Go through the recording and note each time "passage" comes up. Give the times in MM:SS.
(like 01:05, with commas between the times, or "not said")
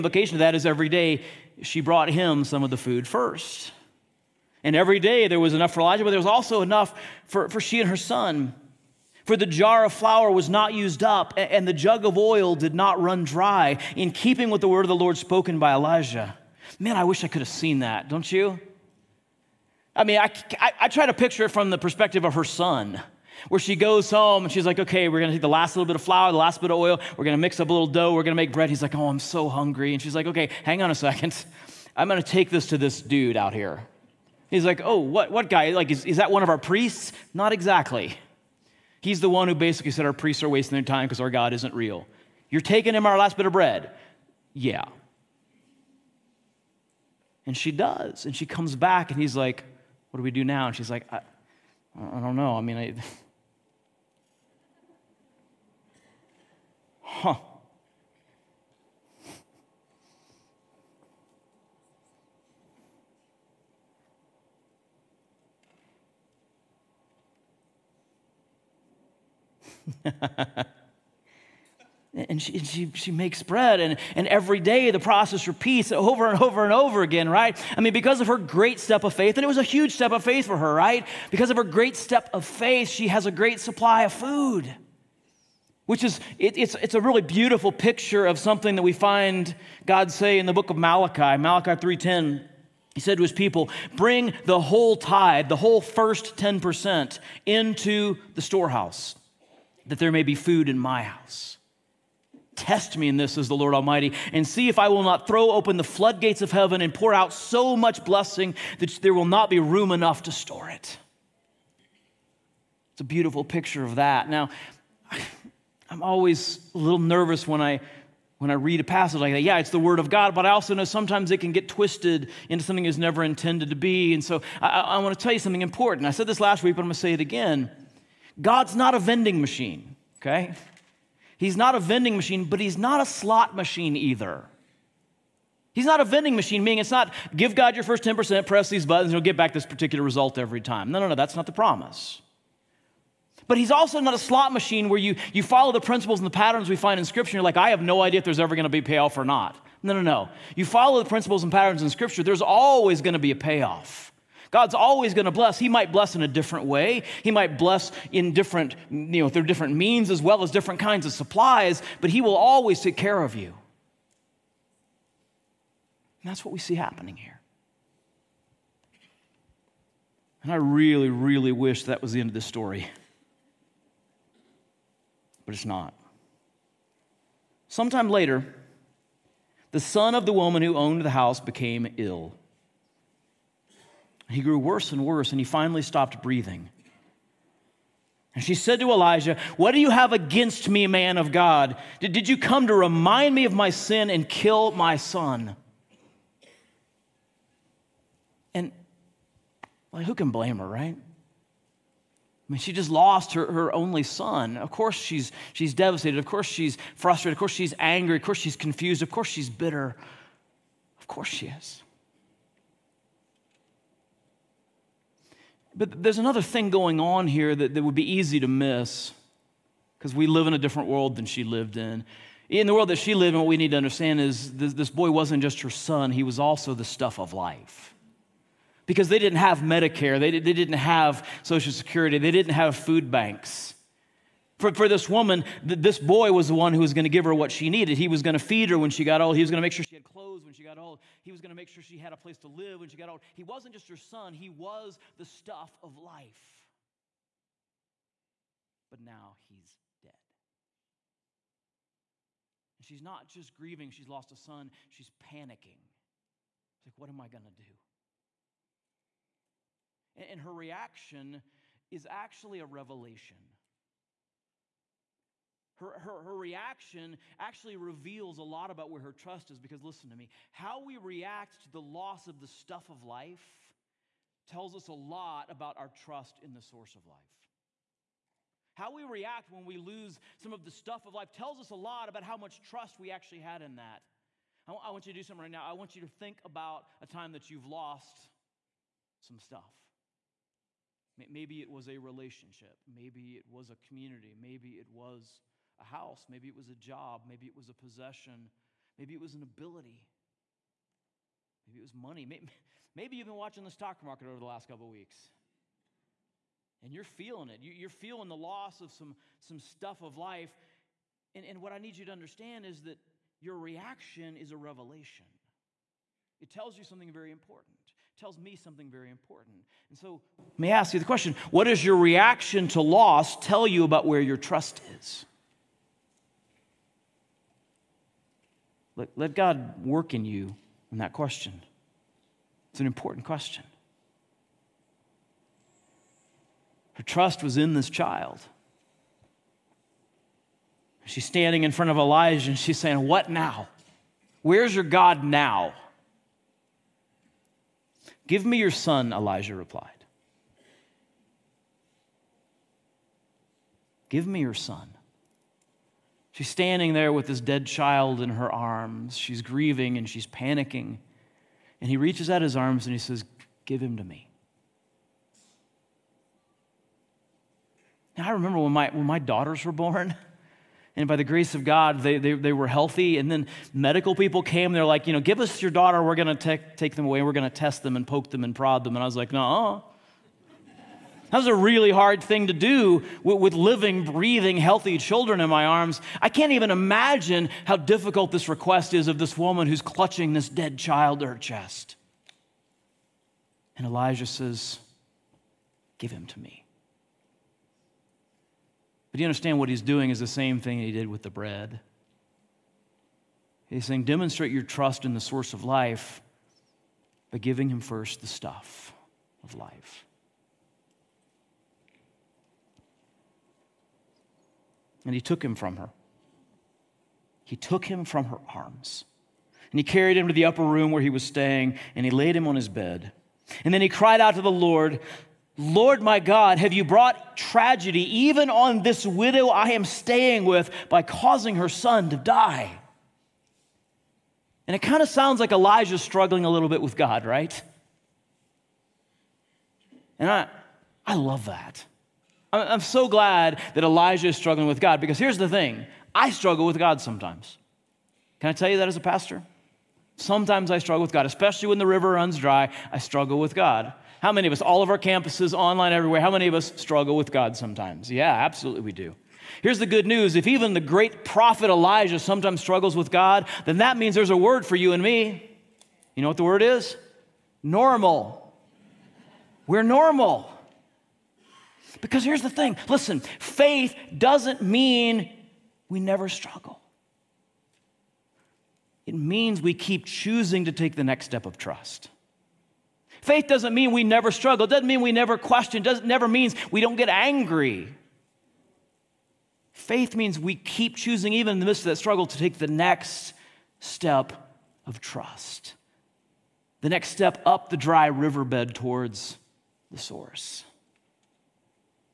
01:58.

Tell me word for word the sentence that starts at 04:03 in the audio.
He wasn't just her son, he was the stuff of life.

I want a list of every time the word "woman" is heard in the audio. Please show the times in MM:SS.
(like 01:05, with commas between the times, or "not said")
03:00, 03:55, 06:29.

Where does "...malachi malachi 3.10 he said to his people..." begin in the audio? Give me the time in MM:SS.
01:30.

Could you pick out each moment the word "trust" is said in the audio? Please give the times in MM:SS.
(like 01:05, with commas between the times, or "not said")
04:29, 04:35, 04:42, 05:24, 05:37, 06:44, 08:01, 08:15.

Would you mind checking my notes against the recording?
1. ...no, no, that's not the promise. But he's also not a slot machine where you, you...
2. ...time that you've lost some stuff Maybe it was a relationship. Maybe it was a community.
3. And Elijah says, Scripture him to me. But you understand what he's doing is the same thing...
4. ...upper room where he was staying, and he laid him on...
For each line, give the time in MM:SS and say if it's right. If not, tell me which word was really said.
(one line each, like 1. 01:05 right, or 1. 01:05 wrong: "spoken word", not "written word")
1. 02:20 right
2. 04:47 right
3. 06:33 wrong: "Give", not "Scripture"
4. 07:00 right.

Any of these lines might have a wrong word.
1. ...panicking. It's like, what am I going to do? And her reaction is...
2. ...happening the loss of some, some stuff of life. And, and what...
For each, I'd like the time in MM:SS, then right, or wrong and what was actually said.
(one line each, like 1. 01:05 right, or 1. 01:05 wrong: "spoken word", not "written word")
1. 04:15 right
2. 05:07 wrong: "feeling", not "happening".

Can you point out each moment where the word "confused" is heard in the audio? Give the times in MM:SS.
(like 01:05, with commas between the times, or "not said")
03:28.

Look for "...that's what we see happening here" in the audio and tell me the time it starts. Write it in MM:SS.
02:46.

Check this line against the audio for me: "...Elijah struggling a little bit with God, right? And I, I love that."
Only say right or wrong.
right.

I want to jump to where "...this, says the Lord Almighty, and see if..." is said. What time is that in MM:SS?
01:43.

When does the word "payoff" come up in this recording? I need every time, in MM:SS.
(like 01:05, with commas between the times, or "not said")
02:28, 02:33.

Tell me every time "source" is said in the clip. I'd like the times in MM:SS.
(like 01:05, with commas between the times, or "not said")
04:36, 06:45, 08:19.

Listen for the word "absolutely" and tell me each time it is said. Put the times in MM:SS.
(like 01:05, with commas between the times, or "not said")
07:38.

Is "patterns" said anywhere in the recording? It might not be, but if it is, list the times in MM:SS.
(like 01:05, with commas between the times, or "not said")
02:26, 02:31.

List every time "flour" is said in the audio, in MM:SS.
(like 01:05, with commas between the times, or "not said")
00:09, 00:26.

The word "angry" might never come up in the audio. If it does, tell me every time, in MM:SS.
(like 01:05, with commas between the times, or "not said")
03:27, 08:07.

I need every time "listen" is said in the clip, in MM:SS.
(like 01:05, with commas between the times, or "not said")
04:29, 07:52.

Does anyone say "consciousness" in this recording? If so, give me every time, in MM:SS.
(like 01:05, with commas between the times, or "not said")
not said.